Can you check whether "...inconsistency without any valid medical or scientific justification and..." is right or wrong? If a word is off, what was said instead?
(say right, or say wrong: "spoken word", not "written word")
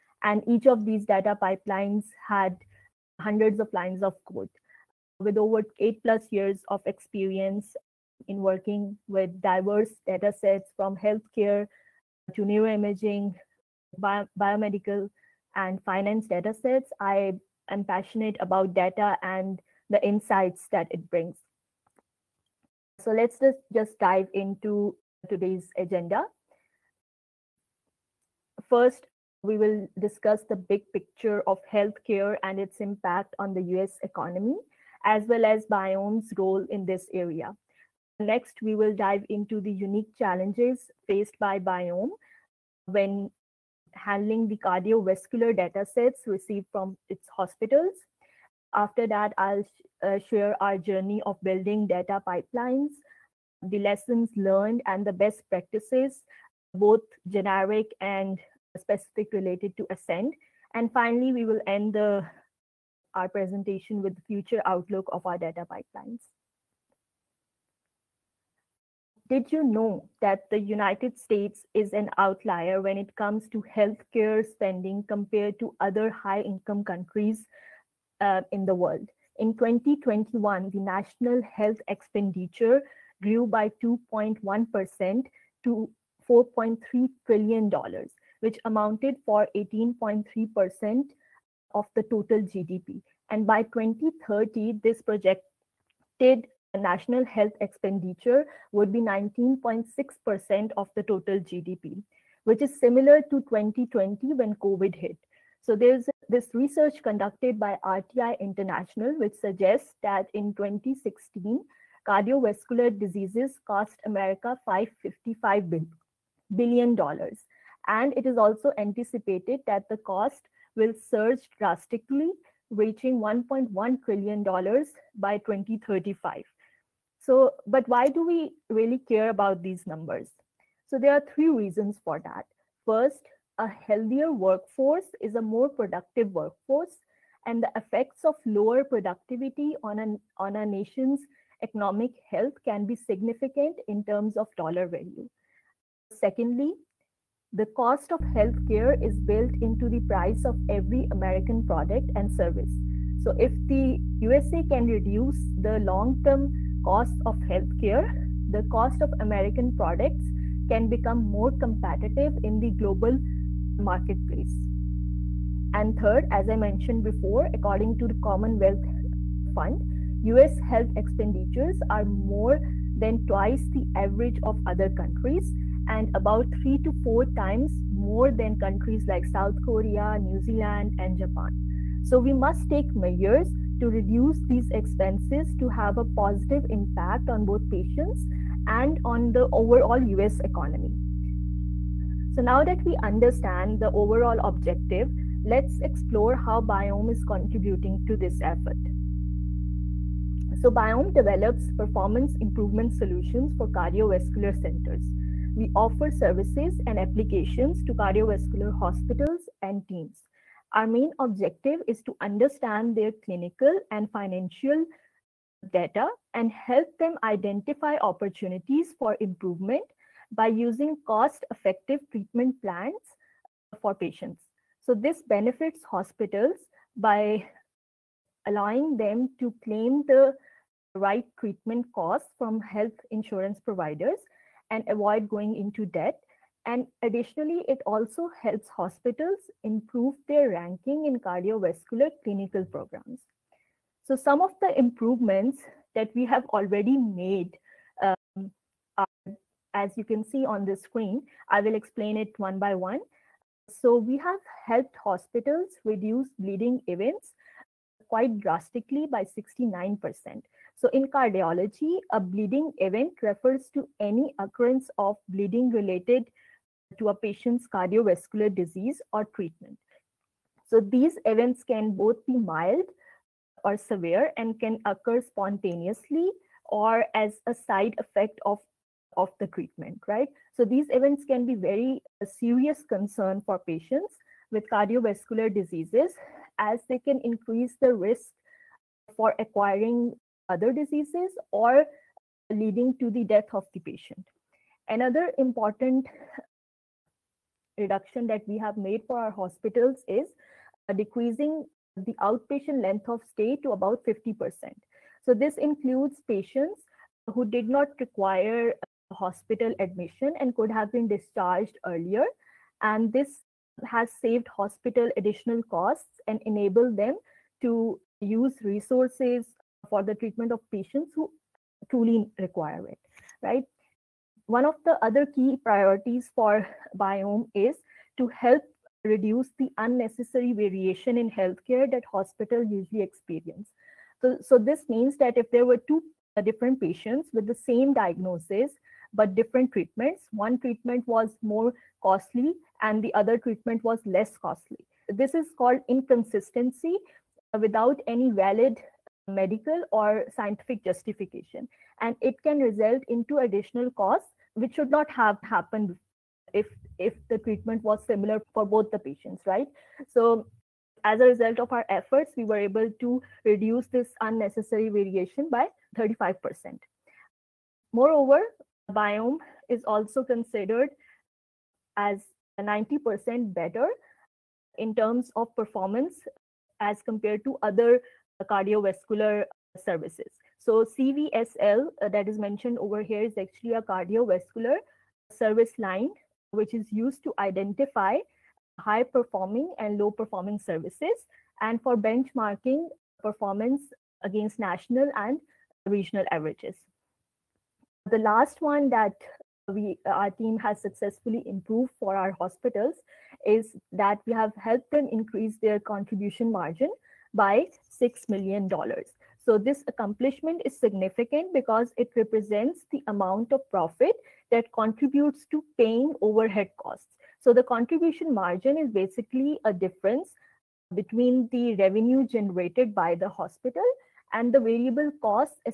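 right.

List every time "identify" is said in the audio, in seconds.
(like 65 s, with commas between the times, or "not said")
217 s, 387 s.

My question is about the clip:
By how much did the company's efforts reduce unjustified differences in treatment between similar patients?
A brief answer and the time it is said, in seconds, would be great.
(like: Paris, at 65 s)
35%, at 365 s.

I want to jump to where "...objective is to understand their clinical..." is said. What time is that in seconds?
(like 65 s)
211 s.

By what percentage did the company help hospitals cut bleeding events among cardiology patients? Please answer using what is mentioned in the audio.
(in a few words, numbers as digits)
69%.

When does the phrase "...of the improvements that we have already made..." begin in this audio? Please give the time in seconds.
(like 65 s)
244 s.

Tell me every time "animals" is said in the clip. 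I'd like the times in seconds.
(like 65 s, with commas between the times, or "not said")
not said.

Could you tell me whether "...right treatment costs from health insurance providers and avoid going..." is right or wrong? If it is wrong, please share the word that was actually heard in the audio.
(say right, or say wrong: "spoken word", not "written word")
right.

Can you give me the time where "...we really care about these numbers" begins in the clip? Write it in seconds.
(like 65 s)
128 s.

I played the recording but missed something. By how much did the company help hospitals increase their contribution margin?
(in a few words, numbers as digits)
6 million dollars.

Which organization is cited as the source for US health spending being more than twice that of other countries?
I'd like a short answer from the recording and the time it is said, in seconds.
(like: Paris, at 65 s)
Commonwealth Fund, at 168 s.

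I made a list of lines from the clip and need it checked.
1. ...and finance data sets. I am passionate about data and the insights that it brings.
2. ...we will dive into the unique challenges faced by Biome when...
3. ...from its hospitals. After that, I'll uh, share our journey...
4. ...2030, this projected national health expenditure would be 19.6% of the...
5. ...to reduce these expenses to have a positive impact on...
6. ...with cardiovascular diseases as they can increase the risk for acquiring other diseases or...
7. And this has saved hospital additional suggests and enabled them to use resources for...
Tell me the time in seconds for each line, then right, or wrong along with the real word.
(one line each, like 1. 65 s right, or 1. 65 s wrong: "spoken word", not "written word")
1. 15 s right
2. 38 s right
3. 46 s right
4. 93 s right
5. 183 s right
6. 284 s right
7. 312 s wrong: "costs", not "suggests".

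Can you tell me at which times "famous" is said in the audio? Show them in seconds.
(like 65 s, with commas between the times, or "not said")
not said.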